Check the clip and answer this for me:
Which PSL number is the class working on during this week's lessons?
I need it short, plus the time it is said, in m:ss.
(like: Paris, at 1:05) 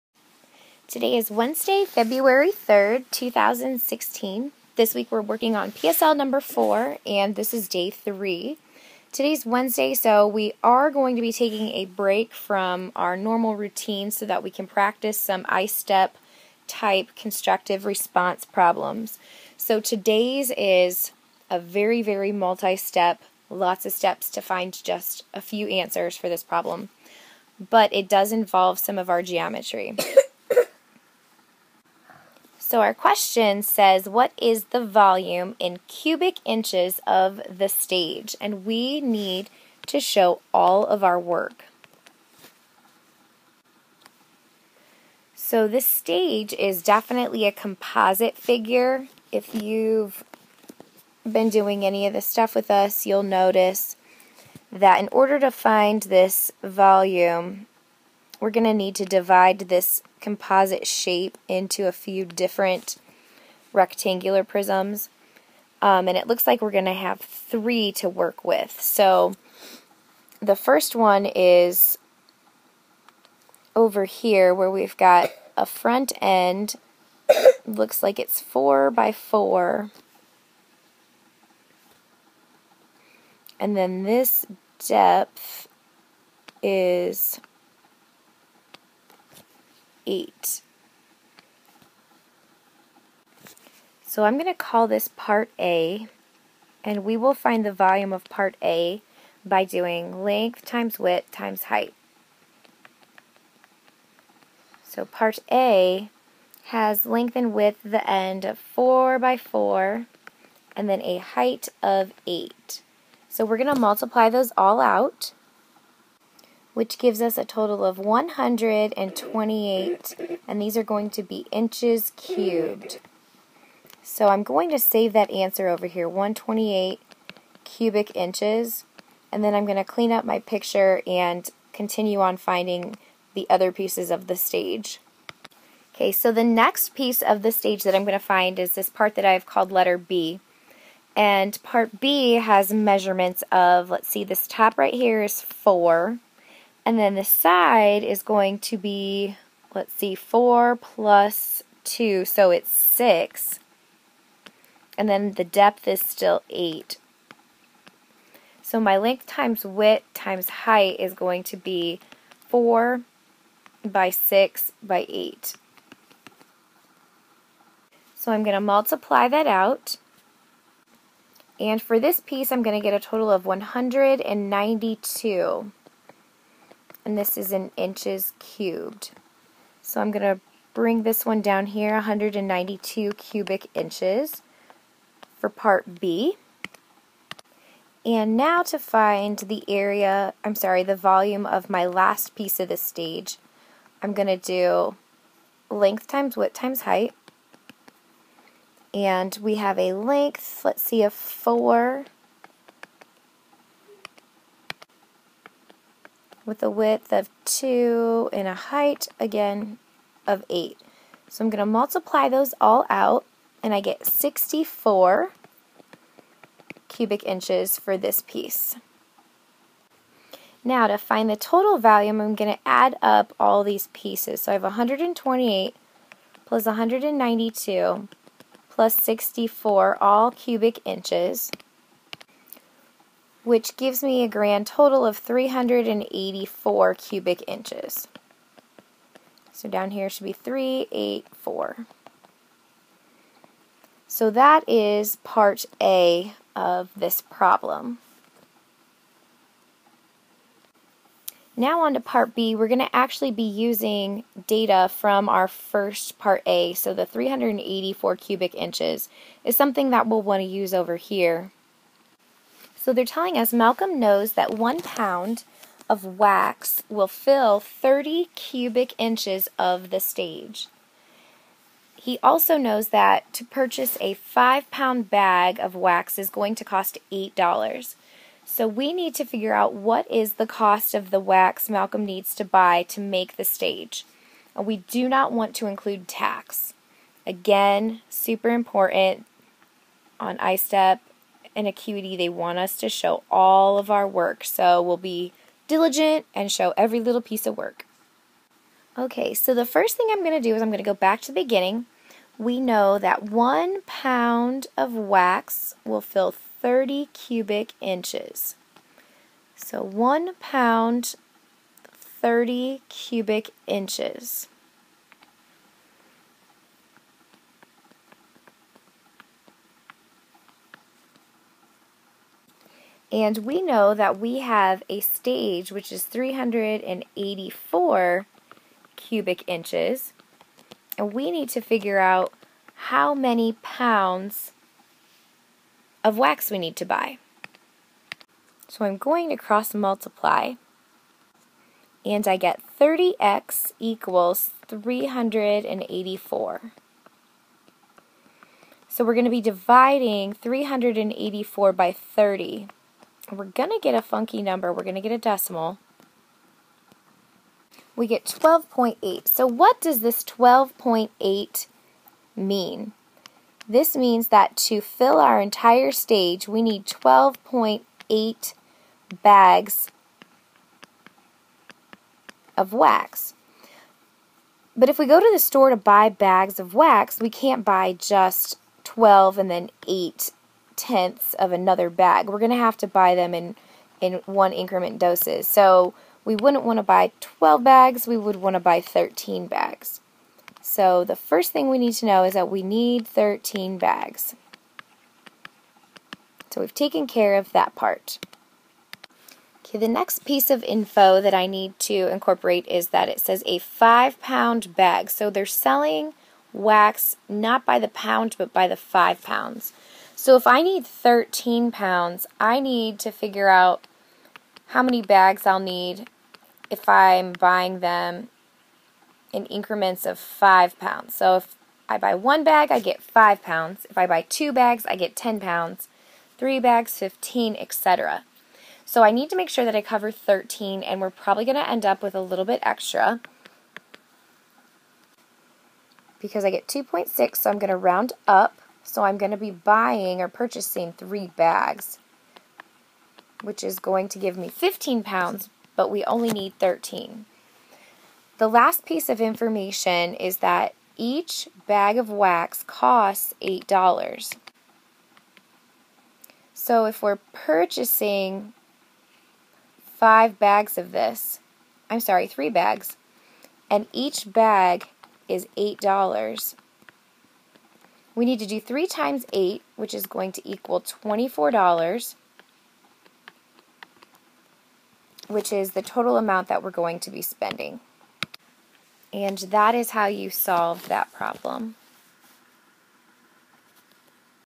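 4, at 0:05.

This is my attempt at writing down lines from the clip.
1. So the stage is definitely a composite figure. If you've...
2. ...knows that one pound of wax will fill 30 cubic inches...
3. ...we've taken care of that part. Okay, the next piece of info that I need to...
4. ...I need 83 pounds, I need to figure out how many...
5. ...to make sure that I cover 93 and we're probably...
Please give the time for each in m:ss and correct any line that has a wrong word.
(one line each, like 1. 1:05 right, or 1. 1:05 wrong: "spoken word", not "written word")
1. 0:45 right
2. 4:23 right
3. 6:36 right
4. 6:50 wrong: "13", not "83"
5. 7:09 wrong: "13", not "93".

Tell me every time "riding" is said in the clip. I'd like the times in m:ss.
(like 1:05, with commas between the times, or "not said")
not said.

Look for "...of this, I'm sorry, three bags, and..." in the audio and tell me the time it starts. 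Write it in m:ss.
7:40.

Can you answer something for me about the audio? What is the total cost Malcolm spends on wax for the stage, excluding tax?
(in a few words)
$24.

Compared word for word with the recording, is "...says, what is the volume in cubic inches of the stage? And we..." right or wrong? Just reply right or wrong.
right.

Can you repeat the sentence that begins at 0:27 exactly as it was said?
But it does involve some of our geometry.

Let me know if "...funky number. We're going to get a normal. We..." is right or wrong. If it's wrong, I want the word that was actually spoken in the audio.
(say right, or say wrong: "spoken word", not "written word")
wrong: "decimal", not "normal".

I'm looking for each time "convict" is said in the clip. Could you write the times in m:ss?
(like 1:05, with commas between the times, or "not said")
not said.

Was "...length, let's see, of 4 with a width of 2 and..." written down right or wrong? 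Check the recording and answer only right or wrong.
right.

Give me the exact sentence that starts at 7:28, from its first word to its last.
The last piece of information is that each bag of wax costs $8.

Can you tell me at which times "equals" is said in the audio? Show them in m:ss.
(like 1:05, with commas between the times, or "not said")
5:43, 7:50.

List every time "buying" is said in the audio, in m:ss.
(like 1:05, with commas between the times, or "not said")
6:57, 7:19.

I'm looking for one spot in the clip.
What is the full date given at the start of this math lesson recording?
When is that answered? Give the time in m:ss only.
0:01.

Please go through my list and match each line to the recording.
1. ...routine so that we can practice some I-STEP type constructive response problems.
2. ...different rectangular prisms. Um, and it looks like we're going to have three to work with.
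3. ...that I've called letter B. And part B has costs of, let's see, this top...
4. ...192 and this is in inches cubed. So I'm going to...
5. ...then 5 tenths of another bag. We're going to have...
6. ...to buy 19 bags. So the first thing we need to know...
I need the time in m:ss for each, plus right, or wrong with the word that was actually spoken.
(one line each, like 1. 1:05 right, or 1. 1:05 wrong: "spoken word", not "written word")
1. 0:13 right
2. 1:02 right
3. 2:19 wrong: "measurements", not "costs"
4. 2:53 right
5. 6:19 wrong: "8", not "5"
6. 6:28 wrong: "13", not "19".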